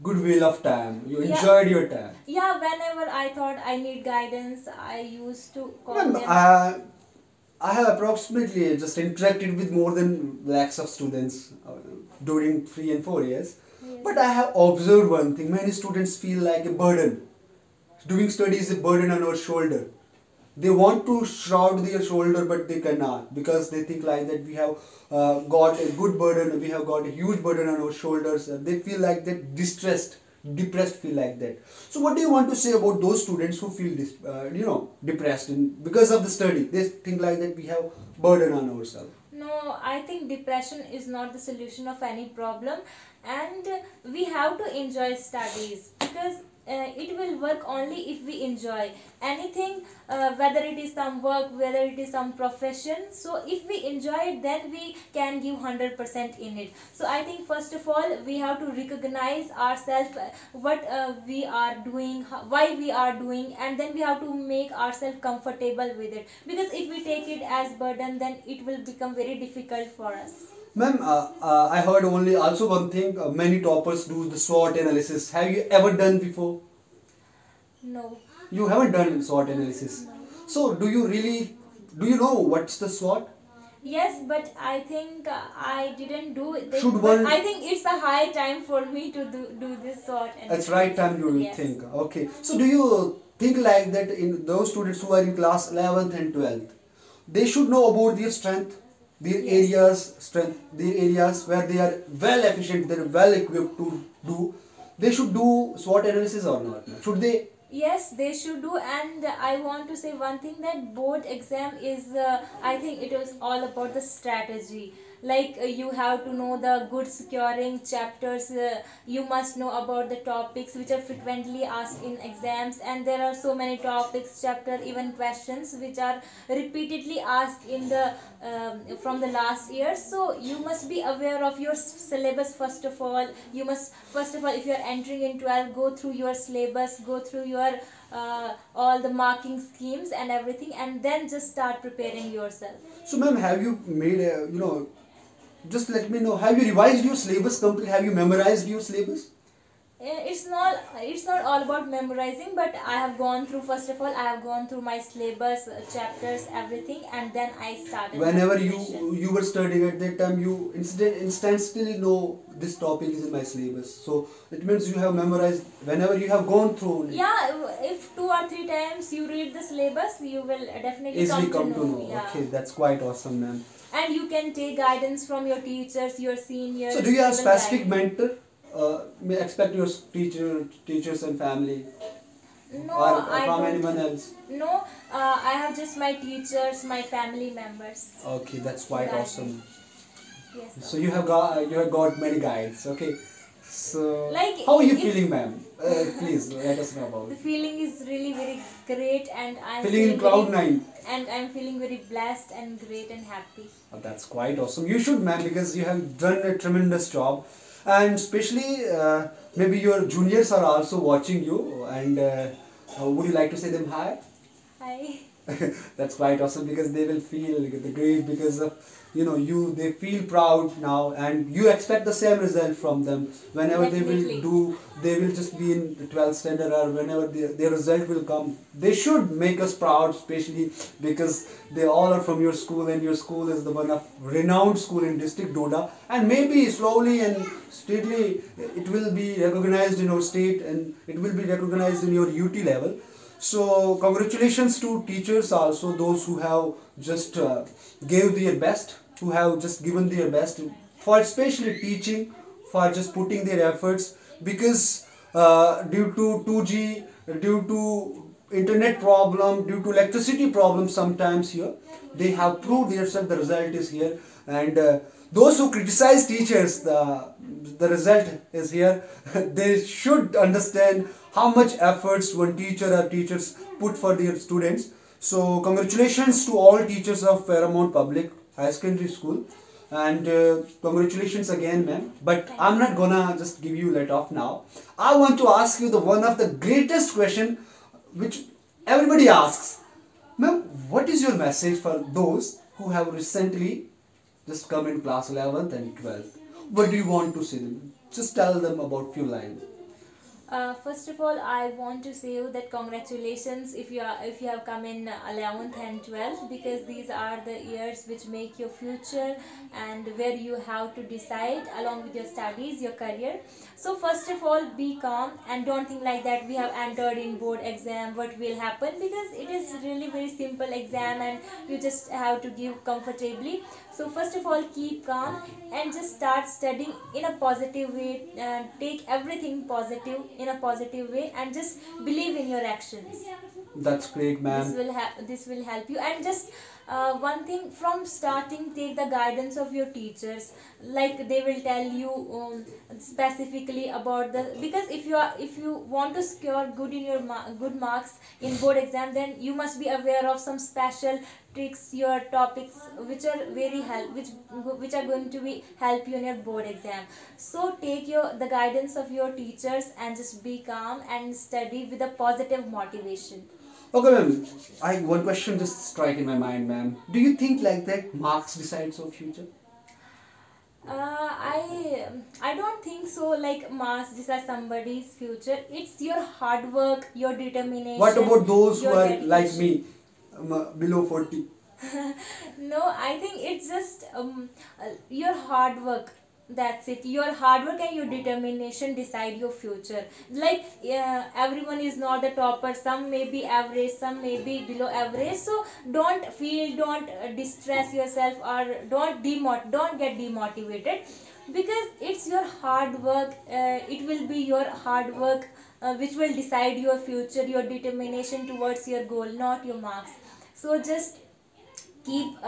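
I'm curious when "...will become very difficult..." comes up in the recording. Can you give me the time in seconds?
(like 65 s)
68 s.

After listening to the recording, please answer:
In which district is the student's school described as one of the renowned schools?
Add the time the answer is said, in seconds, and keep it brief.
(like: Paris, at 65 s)
Doda, at 235 s.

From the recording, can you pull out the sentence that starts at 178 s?
Uh, expect your teacher, teachers and family no, or I from anyone else?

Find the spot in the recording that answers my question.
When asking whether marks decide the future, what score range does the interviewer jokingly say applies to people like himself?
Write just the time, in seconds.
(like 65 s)
380 s.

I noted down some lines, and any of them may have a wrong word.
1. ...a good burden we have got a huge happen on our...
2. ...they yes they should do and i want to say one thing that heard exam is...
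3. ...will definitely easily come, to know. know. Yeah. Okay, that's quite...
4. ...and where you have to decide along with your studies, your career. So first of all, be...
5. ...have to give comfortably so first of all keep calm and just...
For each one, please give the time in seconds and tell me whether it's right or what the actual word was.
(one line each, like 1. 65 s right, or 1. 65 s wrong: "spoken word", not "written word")
1. 25 s wrong: "burden", not "happen"
2. 107 s wrong: "board", not "heard"
3. 170 s right
4. 309 s right
5. 322 s right.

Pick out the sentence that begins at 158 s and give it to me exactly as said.
Whenever you you were studying at that time, you instant instantly know this topic is in my syllabus.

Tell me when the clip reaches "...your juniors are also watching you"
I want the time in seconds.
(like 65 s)
209 s.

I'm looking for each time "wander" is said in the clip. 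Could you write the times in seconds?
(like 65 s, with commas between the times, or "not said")
not said.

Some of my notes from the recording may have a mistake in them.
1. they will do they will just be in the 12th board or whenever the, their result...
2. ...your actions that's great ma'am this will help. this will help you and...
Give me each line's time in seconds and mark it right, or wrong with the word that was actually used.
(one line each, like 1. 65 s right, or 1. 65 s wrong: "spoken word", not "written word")
1. 224 s wrong: "standard", not "board"
2. 332 s right.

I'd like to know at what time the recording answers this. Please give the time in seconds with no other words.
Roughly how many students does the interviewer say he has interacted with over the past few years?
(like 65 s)
9 s.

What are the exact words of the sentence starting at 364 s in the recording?
I one question just strike in my mind, ma'am.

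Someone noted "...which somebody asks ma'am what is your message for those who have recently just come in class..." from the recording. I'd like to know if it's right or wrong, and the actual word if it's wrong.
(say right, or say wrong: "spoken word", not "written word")
wrong: "everybody", not "somebody".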